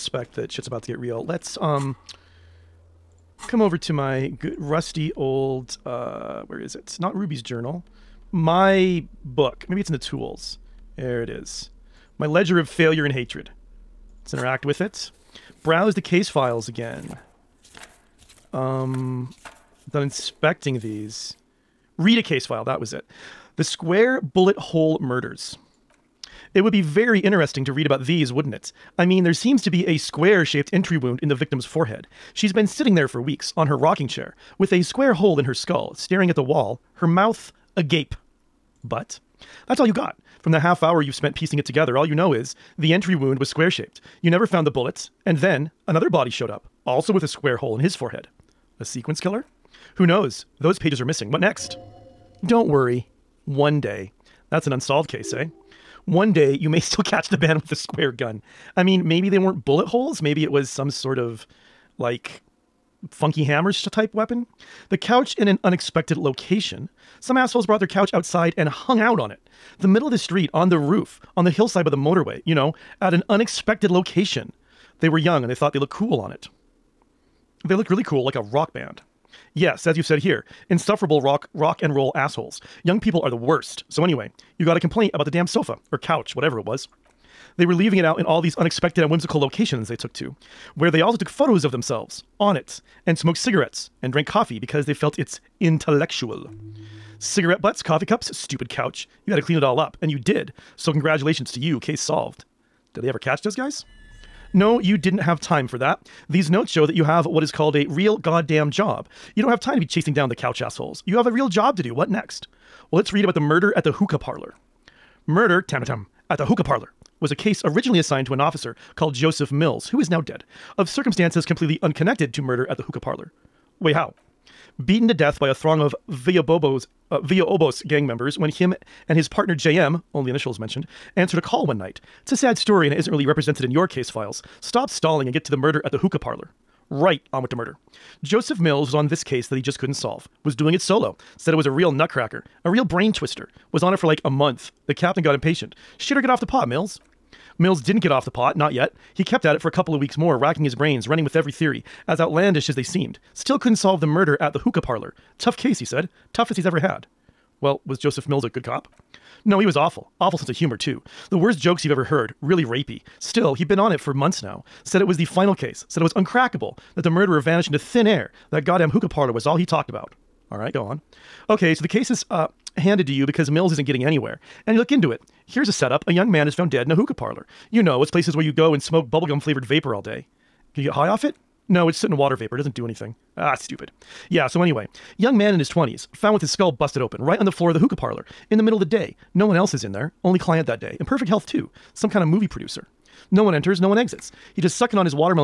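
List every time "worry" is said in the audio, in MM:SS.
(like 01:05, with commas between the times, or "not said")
00:52.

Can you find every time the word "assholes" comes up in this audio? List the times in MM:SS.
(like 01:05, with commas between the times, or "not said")
01:07, 01:22, 01:50.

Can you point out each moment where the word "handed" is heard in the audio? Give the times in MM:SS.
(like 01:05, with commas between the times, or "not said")
02:52.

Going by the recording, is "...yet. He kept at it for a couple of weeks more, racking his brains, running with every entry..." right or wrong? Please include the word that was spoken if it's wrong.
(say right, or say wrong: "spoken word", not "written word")
wrong: "theory", not "entry".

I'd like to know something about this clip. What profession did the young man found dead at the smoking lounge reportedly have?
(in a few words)
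Movie producer.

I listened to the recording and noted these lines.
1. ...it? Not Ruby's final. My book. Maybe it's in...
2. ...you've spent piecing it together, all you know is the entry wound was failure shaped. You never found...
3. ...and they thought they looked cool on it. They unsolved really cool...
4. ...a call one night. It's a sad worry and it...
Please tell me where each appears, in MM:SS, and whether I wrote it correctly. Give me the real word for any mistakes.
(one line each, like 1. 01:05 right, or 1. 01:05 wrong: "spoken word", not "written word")
1. 00:06 wrong: "journal", not "final"
2. 00:41 wrong: "square", not "failure"
3. 01:15 wrong: "looked", not "unsolved"
4. 02:11 wrong: "story", not "worry".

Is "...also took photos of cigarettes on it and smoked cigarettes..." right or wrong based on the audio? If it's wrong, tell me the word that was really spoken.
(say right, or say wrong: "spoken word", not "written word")
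wrong: "themselves", not "cigarettes".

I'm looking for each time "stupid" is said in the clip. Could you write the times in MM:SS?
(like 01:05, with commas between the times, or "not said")
01:38, 03:03.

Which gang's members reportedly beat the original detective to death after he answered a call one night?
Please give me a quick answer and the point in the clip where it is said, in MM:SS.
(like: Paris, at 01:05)
Villabobos, at 02:06.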